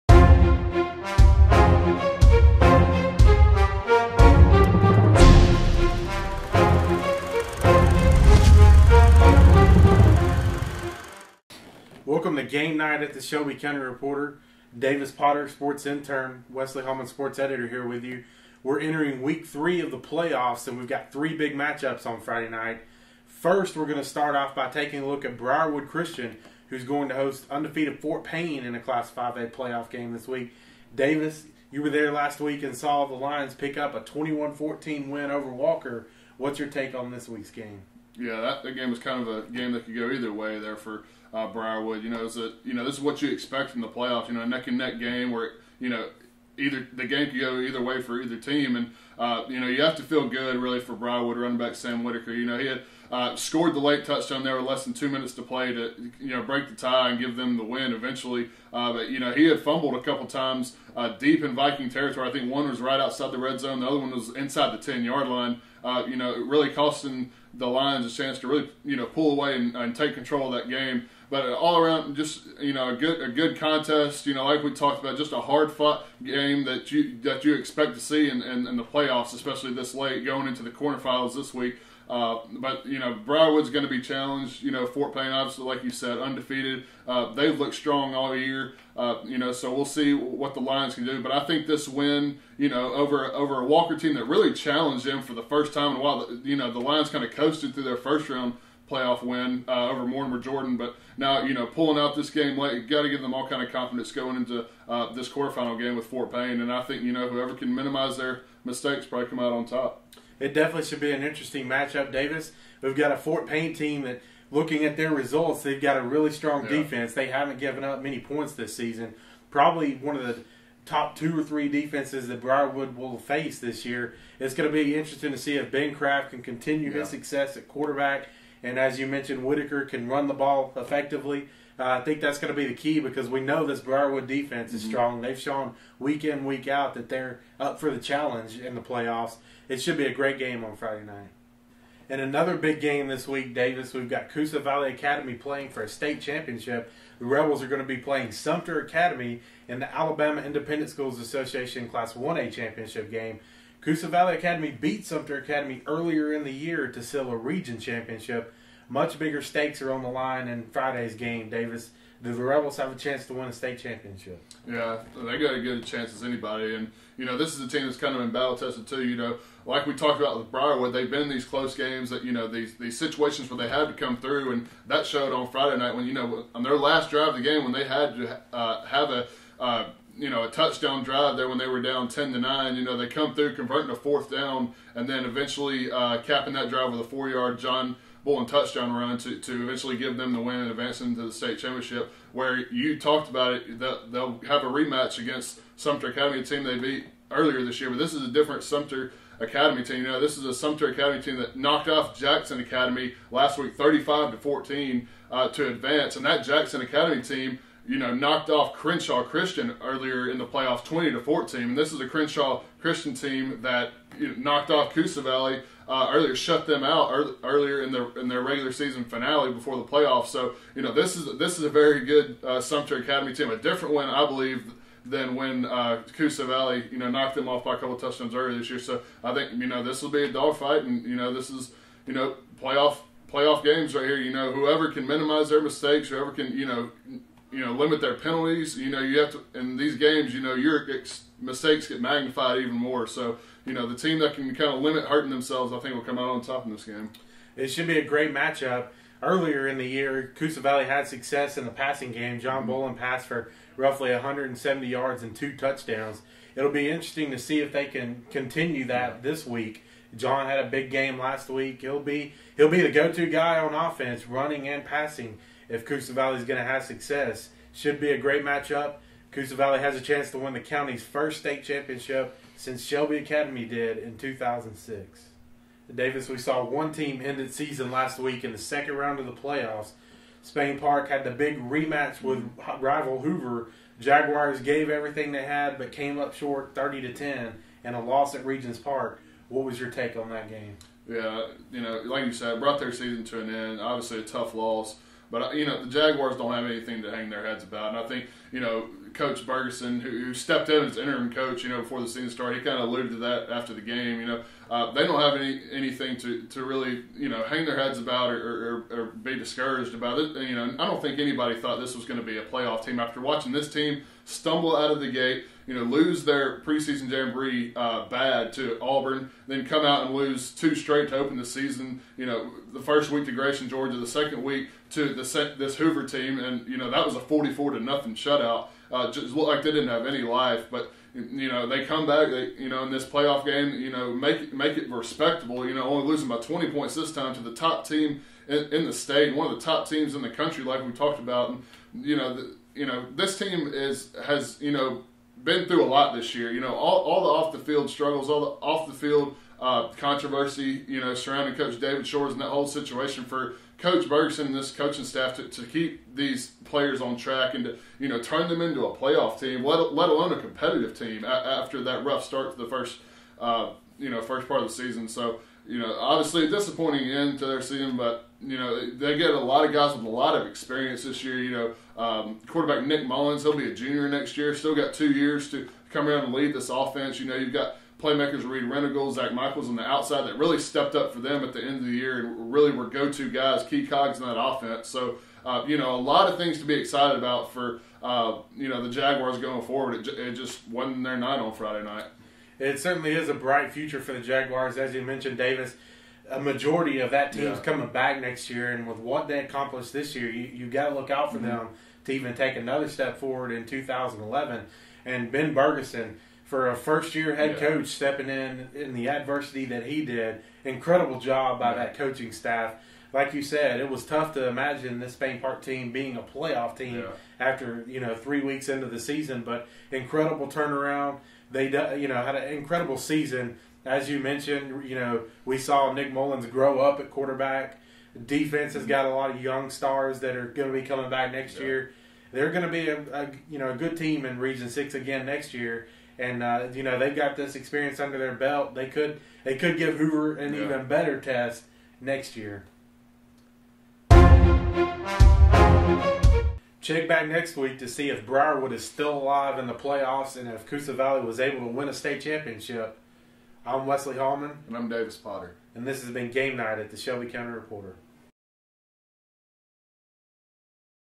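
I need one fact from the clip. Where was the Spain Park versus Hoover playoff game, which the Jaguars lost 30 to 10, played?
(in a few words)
Regions Park.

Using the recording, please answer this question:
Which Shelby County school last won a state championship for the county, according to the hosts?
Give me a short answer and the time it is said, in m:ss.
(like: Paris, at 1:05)
Shelby Academy, at 4:32.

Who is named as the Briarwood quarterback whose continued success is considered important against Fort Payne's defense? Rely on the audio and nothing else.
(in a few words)
Ben Craft.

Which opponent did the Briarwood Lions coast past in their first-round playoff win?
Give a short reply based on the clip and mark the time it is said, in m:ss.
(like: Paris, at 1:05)
Mortimer Jordan, at 1:40.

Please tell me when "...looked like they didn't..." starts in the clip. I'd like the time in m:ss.
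5:29.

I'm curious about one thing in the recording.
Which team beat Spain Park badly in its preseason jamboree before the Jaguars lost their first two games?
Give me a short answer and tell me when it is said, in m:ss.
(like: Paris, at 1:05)
Auburn, at 5:18.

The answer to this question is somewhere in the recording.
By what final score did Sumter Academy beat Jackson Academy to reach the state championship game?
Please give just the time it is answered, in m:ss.
3:23.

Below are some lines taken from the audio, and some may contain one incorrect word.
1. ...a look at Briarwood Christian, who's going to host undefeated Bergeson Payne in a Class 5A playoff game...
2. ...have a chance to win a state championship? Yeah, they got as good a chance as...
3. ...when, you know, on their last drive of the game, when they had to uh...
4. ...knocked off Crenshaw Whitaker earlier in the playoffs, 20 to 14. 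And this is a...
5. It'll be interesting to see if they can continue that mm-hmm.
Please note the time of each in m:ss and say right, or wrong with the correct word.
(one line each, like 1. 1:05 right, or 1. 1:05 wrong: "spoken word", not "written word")
1. 0:25 wrong: "Fort", not "Bergeson"
2. 2:42 right
3. 2:55 right
4. 3:28 wrong: "Christian", not "Whitaker"
5. 4:16 right.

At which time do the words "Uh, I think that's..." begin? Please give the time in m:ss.
2:11.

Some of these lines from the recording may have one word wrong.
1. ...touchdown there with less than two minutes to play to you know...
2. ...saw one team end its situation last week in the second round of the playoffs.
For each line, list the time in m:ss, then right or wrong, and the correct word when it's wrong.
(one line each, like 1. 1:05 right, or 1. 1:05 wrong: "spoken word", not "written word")
1. 0:54 right
2. 4:36 wrong: "season", not "situation".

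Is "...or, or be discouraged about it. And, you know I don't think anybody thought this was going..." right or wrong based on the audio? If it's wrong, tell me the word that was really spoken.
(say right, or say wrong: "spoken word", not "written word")
right.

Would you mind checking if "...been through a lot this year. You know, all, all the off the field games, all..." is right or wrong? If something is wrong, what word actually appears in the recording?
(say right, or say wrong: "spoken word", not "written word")
wrong: "struggles", not "games".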